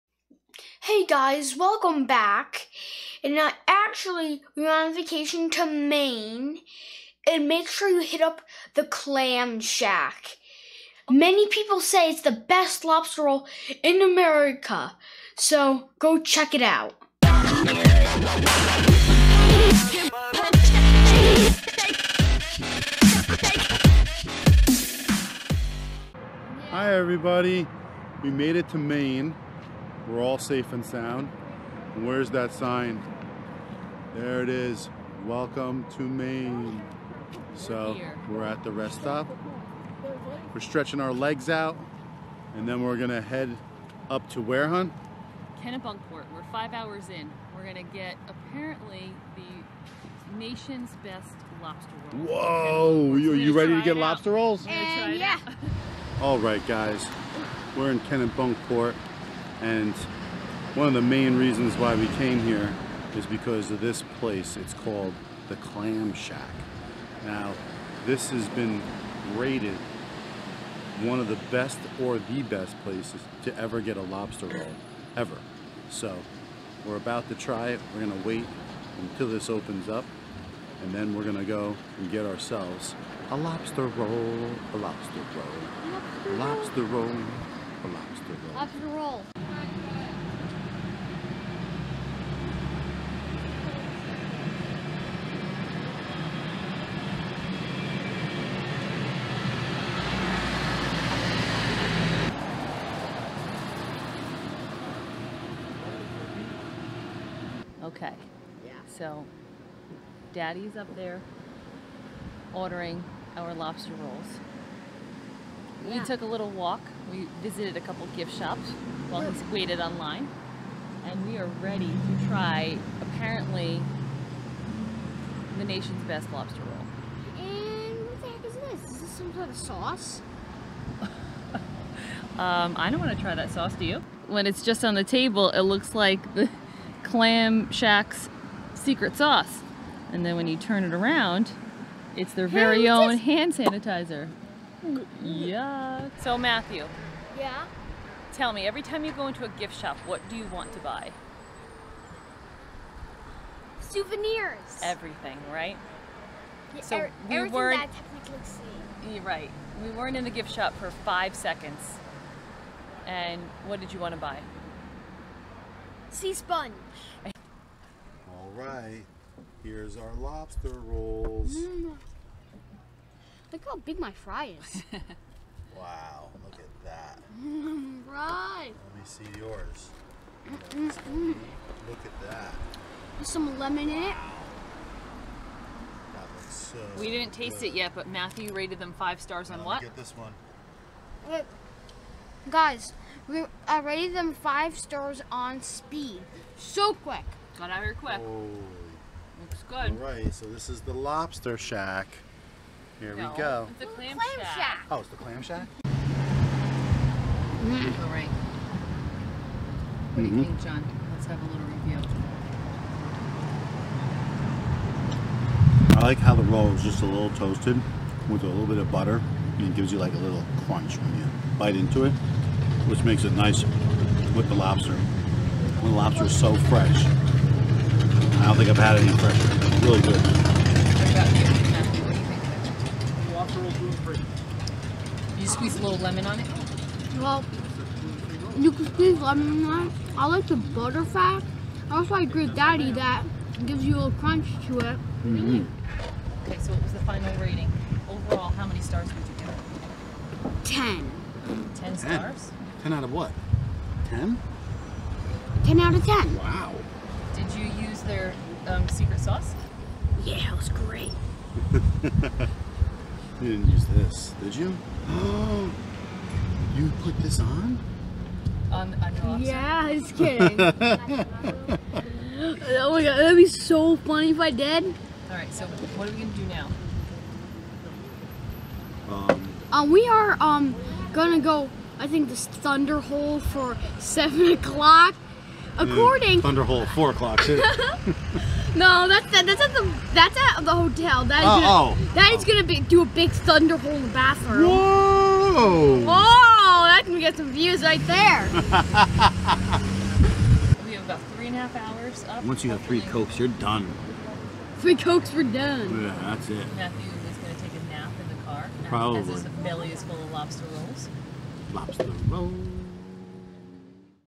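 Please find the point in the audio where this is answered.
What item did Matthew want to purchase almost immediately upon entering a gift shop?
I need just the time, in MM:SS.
02:46.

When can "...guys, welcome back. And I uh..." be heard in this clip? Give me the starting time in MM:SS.
00:01.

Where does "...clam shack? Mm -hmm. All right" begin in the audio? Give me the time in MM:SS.
03:25.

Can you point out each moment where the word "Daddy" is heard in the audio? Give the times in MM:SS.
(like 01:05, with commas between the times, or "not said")
01:50, 04:02.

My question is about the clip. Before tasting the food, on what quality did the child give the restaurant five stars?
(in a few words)
Speed.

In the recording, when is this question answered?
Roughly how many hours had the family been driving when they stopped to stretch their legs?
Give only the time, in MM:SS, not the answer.
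00:46.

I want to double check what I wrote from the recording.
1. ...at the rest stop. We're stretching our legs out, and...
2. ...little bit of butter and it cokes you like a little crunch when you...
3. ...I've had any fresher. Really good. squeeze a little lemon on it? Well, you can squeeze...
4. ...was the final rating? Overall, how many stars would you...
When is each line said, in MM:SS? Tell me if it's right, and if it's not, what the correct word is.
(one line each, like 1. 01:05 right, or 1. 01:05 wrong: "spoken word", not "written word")
1. 00:38 right
2. 03:38 wrong: "gives", not "cokes"
3. 03:48 right
4. 04:06 right.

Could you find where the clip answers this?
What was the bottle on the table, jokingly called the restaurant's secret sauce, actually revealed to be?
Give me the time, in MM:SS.
02:23.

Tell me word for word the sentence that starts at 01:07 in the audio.
Now, this has been rated one of the best or the best places to ever get a lobster roll, ever.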